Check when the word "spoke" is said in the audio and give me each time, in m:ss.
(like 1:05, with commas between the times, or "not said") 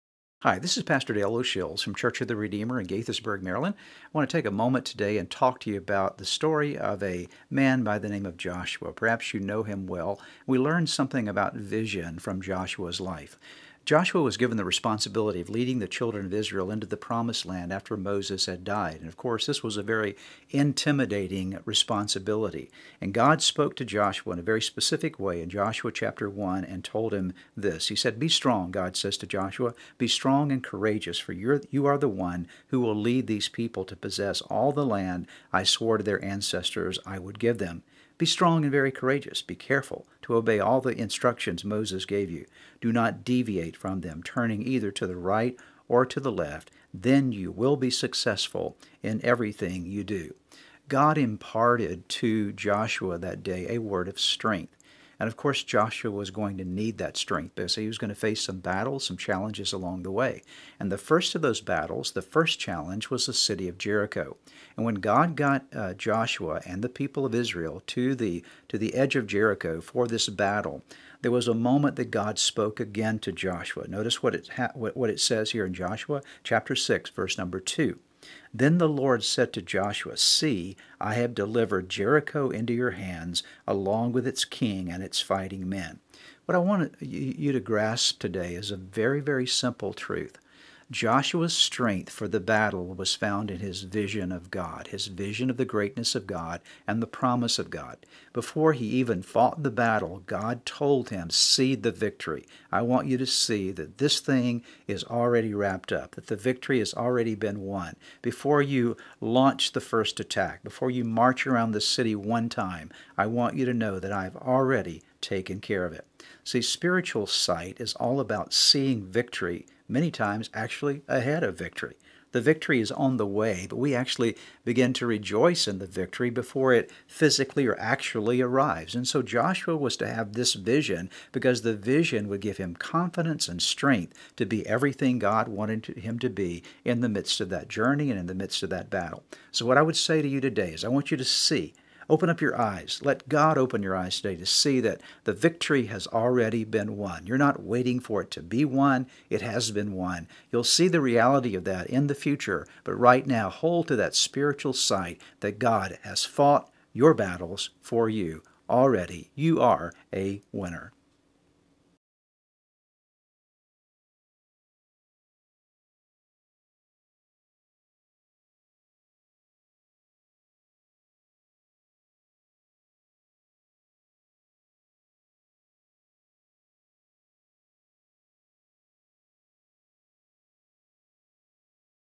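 0:23, 1:12.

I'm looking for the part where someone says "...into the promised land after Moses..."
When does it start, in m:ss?
0:16.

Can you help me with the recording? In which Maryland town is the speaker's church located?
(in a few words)
Gaithersburg.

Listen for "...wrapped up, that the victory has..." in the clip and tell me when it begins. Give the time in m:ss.
1:45.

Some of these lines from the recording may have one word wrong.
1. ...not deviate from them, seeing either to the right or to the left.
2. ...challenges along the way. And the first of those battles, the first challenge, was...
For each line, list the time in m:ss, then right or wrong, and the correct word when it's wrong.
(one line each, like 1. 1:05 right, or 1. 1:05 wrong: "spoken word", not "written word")
1. 0:42 wrong: "turning", not "seeing"
2. 0:59 right.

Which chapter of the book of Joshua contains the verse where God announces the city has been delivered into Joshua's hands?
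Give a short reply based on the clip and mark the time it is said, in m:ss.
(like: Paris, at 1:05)
Chapter 6, at 1:16.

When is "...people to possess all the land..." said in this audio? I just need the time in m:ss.
0:33.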